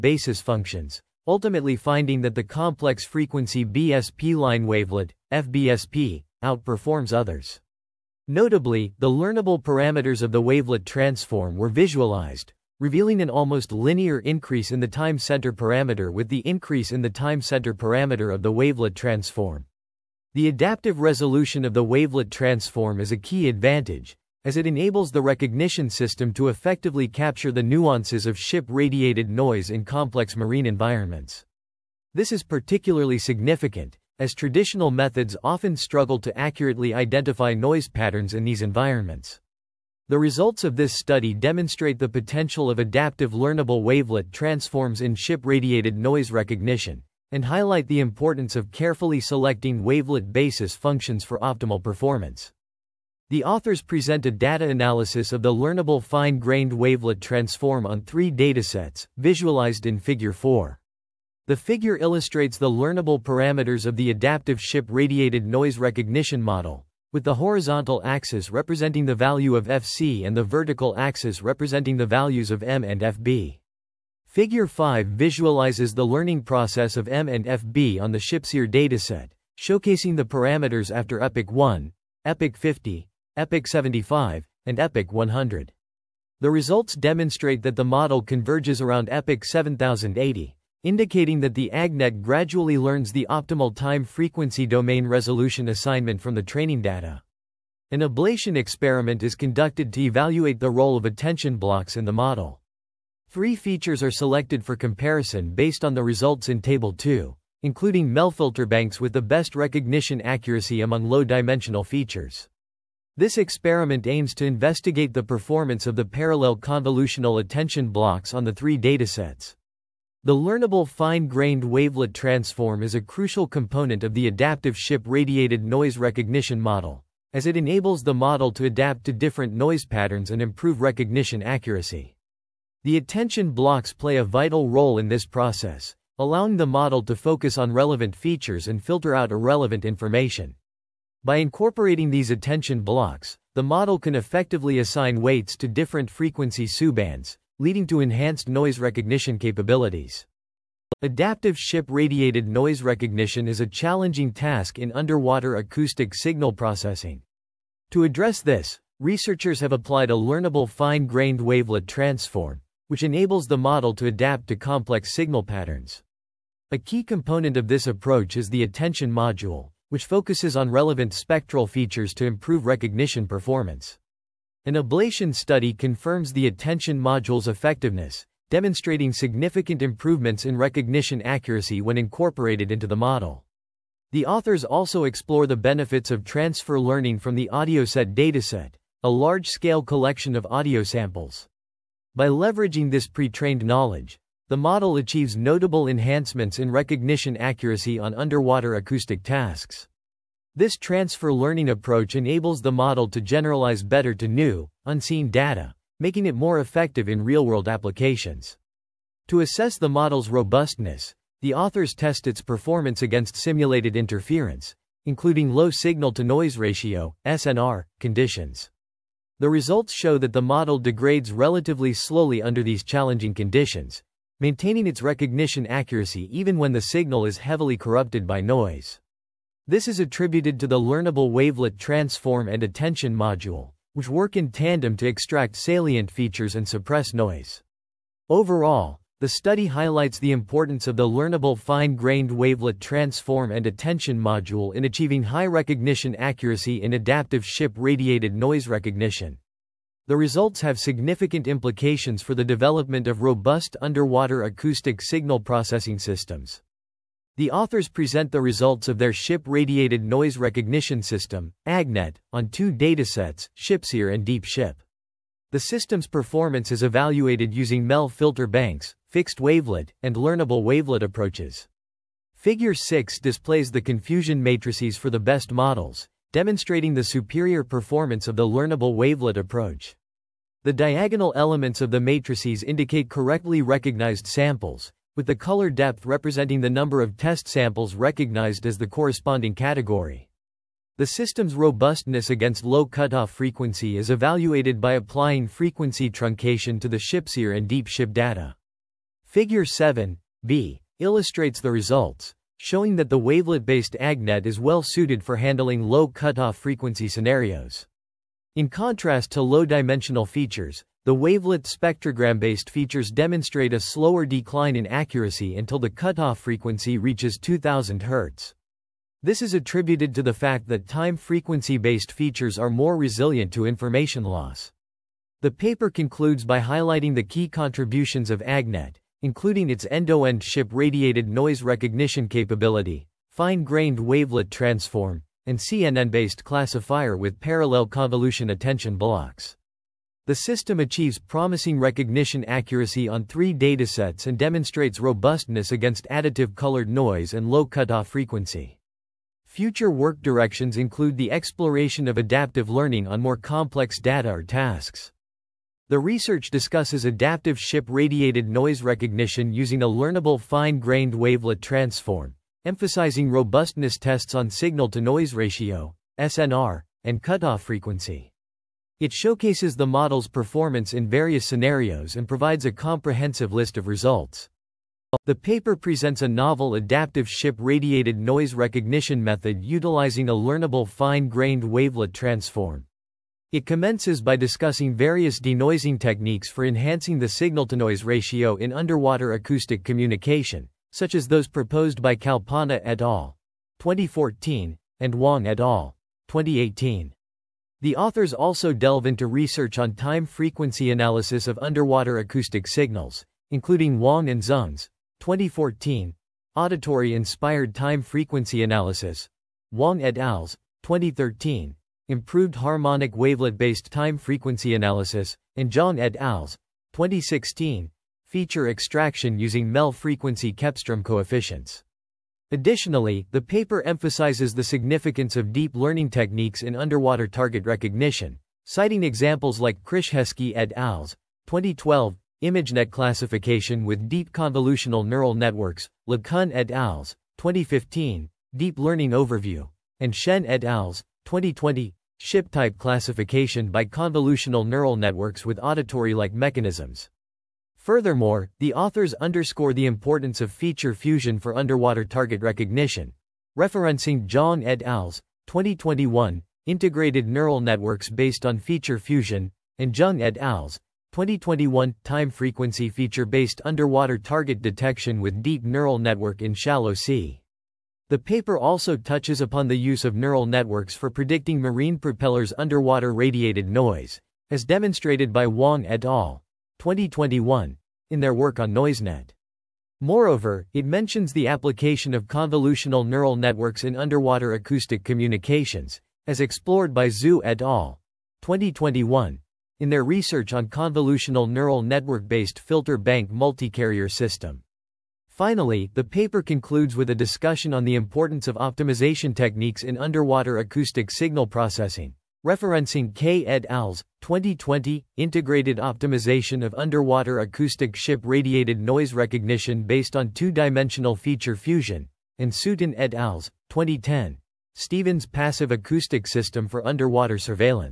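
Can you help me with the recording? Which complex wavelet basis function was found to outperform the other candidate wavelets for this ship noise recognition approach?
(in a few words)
FBSP.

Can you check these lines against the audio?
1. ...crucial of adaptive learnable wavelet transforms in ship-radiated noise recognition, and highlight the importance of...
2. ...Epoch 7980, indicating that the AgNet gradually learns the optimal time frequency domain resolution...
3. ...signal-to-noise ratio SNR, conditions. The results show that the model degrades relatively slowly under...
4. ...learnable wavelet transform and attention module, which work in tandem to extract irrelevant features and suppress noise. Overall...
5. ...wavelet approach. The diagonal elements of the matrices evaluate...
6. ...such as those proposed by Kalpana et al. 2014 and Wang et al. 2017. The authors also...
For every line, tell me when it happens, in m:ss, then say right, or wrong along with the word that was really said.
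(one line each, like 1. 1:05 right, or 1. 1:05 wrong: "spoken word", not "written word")
1. 0:42 wrong: "potential", not "crucial"
2. 1:29 wrong: "7080", not "7980"
3. 3:35 right
4. 3:50 wrong: "salient", not "irrelevant"
5. 4:38 wrong: "indicate", not "evaluate"
6. 6:30 wrong: "2018", not "2017".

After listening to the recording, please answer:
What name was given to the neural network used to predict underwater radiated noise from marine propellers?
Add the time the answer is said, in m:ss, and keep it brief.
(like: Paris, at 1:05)
NoiseNet, at 7:58.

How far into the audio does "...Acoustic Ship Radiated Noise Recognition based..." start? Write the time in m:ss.
8:27.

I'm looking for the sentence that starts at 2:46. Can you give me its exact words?
A key component of this approach is the attention module, which focuses on relevant spectral features to improve recognition performance.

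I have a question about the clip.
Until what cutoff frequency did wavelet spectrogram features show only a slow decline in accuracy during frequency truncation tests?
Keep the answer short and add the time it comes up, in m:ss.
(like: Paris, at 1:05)
2000 Hz, at 5:17.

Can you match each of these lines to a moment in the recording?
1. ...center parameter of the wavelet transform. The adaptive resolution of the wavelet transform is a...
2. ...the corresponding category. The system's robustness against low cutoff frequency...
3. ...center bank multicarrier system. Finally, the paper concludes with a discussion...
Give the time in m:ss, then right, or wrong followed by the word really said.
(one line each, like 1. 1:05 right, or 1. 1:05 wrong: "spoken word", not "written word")
1. 0:17 right
2. 4:48 right
3. 8:12 wrong: "filter", not "center".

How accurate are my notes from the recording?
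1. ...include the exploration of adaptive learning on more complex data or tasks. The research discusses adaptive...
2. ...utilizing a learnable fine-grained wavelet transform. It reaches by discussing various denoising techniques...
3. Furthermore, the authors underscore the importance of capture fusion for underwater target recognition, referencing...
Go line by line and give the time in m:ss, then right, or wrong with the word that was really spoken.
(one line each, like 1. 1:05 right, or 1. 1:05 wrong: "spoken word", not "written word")
1. 5:50 right
2. 6:19 wrong: "commences", not "reaches"
3. 7:27 wrong: "feature", not "capture".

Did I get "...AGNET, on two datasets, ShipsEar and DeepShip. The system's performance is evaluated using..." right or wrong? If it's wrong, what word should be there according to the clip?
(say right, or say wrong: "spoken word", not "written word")
right.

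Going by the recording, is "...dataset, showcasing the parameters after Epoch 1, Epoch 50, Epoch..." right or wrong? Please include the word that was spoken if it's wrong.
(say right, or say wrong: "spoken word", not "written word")
right.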